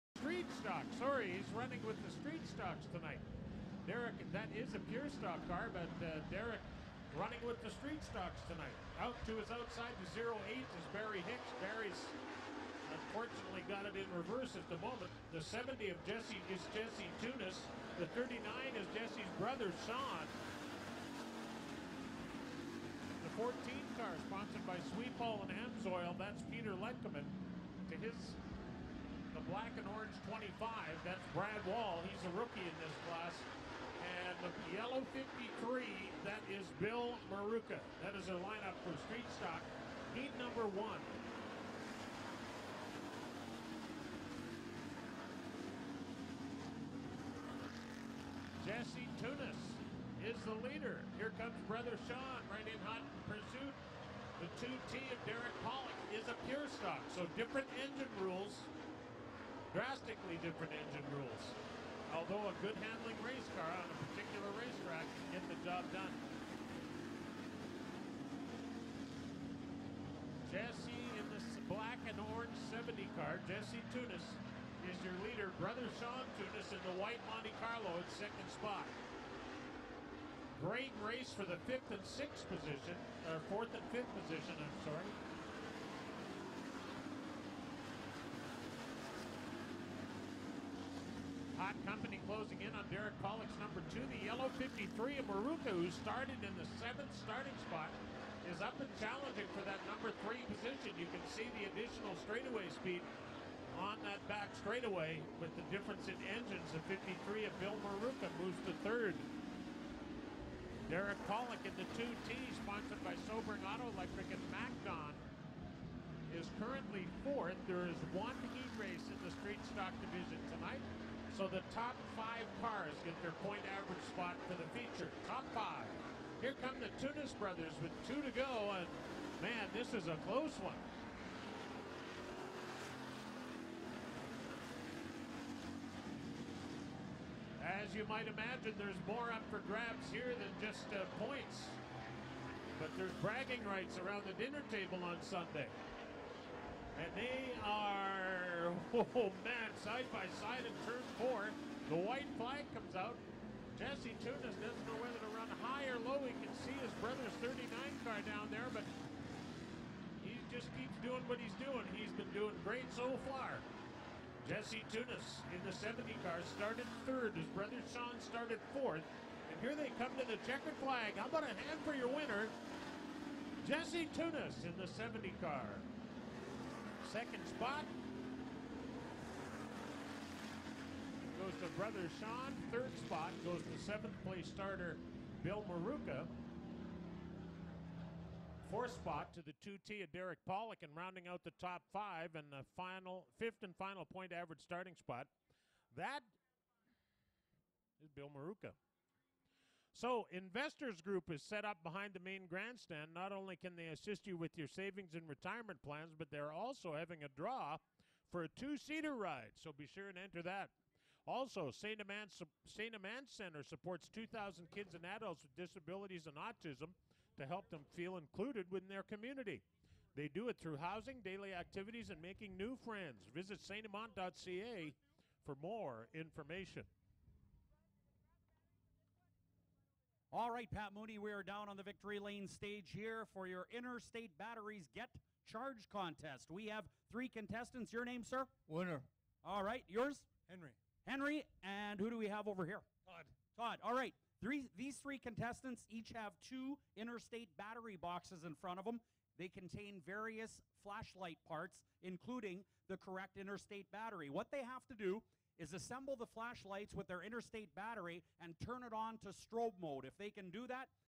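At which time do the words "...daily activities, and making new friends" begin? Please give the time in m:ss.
3:41.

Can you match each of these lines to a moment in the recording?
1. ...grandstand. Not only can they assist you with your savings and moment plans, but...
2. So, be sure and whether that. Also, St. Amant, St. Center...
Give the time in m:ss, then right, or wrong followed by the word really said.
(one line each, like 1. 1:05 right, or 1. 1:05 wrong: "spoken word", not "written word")
1. 3:22 wrong: "retirement", not "moment"
2. 3:29 wrong: "enter", not "whether".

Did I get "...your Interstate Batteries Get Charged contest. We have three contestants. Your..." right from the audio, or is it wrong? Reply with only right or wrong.
right.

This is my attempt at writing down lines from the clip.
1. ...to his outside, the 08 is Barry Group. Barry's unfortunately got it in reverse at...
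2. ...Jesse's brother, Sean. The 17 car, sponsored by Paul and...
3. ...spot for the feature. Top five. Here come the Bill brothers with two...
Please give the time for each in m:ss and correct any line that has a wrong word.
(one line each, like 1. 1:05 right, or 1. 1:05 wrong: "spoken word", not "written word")
1. 0:09 wrong: "Hicks", not "Group"
2. 0:18 wrong: "14", not "17"
3. 2:04 wrong: "Tunis", not "Bill".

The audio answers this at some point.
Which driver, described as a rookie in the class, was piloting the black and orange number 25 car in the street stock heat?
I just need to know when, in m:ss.
0:31.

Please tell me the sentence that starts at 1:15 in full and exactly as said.
Brother Sean Tunis in the white Monte Carlo in second spot.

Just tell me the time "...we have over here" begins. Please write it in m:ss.
4:02.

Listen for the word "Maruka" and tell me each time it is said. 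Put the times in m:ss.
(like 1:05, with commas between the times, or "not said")
0:37, 1:35, 1:47, 3:05, 3:18.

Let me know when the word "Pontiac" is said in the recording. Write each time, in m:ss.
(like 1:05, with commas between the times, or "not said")
not said.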